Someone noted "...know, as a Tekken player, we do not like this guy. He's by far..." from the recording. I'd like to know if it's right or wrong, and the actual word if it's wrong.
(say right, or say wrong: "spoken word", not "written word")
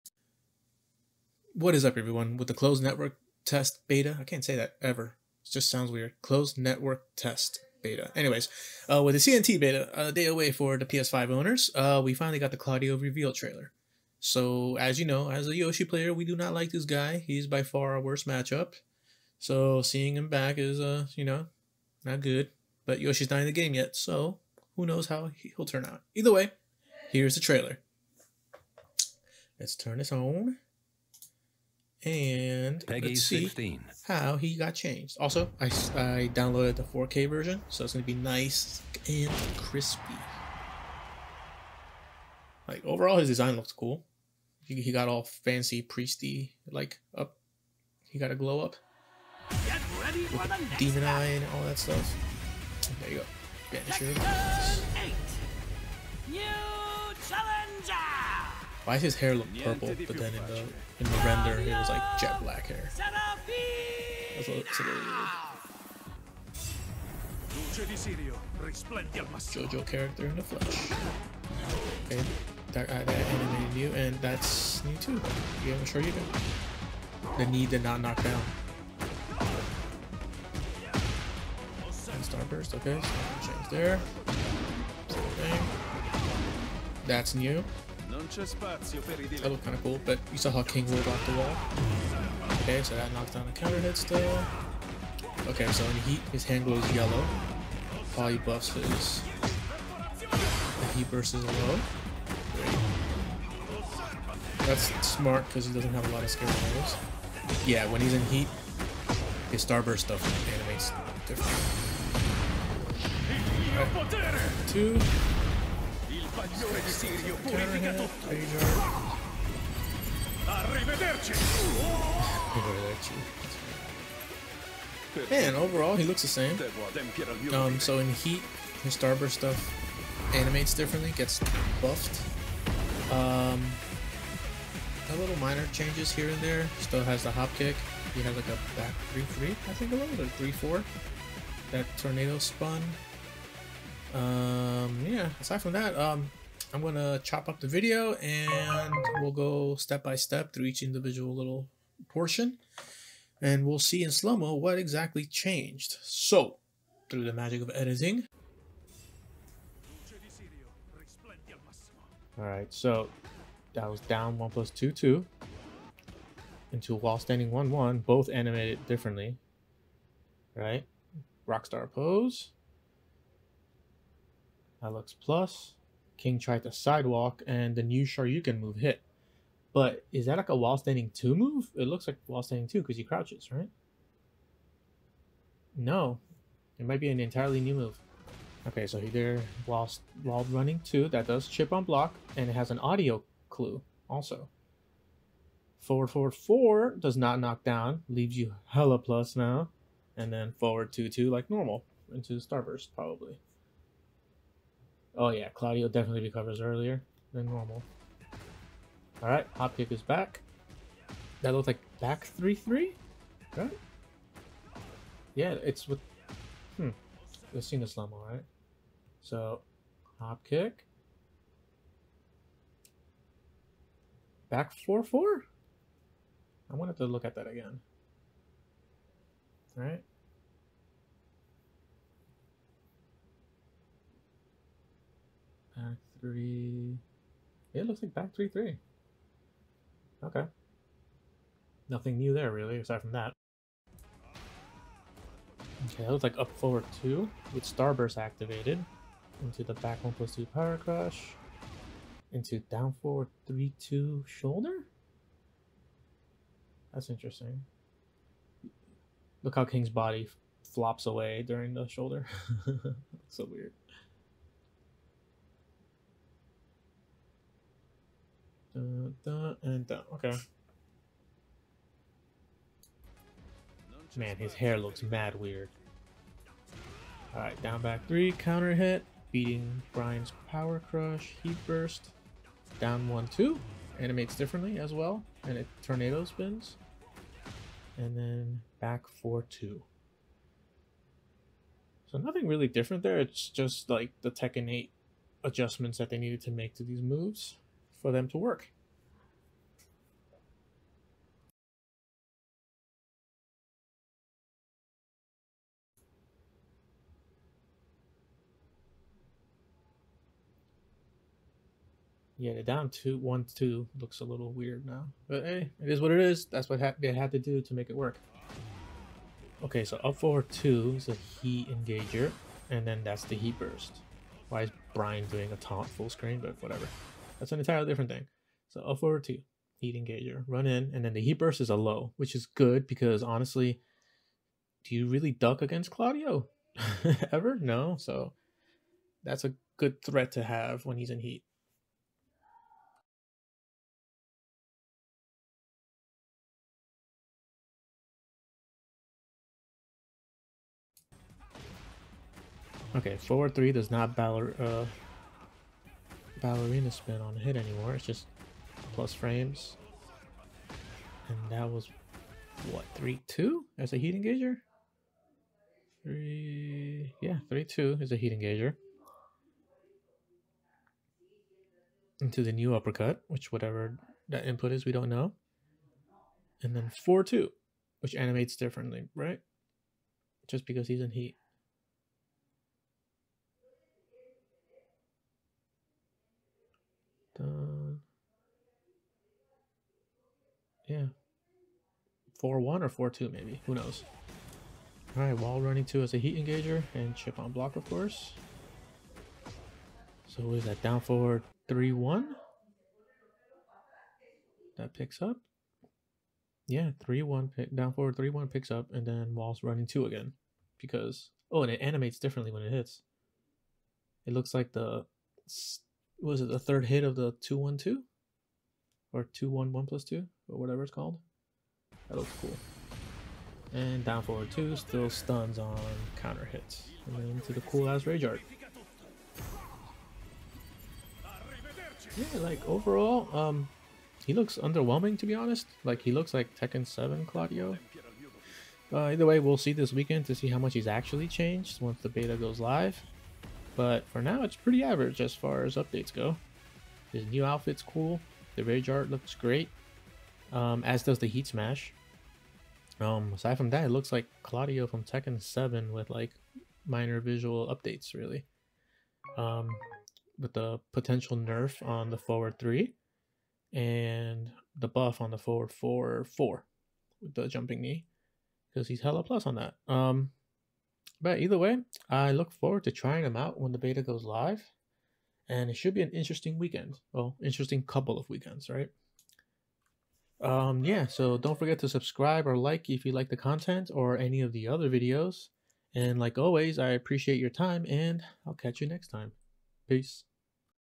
wrong: "Yoshi", not "Tekken".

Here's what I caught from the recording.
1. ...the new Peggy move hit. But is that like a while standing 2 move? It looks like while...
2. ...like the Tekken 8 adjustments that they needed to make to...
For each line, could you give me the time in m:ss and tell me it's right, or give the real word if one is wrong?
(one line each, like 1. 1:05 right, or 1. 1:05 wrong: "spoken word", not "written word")
1. 2:57 wrong: "Shoryuken", not "Peggy"
2. 4:53 right.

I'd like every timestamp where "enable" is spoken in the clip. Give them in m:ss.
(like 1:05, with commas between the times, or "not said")
not said.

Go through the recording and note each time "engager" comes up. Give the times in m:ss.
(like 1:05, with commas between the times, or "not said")
5:21, 5:29, 6:04, 6:08, 6:36.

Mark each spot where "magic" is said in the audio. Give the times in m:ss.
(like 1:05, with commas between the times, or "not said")
2:37.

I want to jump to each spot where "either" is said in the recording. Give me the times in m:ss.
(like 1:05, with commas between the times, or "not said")
0:26, 7:19, 7:51.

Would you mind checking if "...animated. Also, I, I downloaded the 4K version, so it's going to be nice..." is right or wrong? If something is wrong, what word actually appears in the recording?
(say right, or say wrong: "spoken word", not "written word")
wrong: "changed", not "animated".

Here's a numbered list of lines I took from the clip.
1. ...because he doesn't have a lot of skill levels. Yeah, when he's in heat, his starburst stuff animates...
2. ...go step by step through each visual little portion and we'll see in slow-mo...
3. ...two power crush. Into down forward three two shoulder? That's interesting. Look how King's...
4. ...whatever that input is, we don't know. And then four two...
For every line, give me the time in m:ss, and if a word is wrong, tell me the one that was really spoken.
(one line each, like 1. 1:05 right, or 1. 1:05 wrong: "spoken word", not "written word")
1. 1:45 right
2. 2:29 wrong: "individual", not "visual"
3. 4:10 right
4. 6:13 right.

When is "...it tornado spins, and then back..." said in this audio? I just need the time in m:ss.
4:45.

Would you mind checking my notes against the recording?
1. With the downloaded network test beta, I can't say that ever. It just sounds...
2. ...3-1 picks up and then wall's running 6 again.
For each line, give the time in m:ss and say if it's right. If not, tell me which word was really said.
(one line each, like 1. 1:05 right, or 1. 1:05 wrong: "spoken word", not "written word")
1. 0:02 wrong: "closed", not "downloaded"
2. 6:48 wrong: "2", not "6".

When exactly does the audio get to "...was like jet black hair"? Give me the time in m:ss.
1:01.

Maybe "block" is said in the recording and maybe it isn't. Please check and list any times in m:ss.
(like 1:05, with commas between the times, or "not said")
3:11, 6:37.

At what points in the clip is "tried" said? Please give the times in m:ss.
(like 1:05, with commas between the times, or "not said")
2:56.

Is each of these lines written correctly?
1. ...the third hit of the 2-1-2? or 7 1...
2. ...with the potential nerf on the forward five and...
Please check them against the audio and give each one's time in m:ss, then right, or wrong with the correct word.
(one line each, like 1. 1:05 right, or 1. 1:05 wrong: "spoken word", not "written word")
1. 6:56 wrong: "2", not "7"
2. 7:40 wrong: "three", not "five".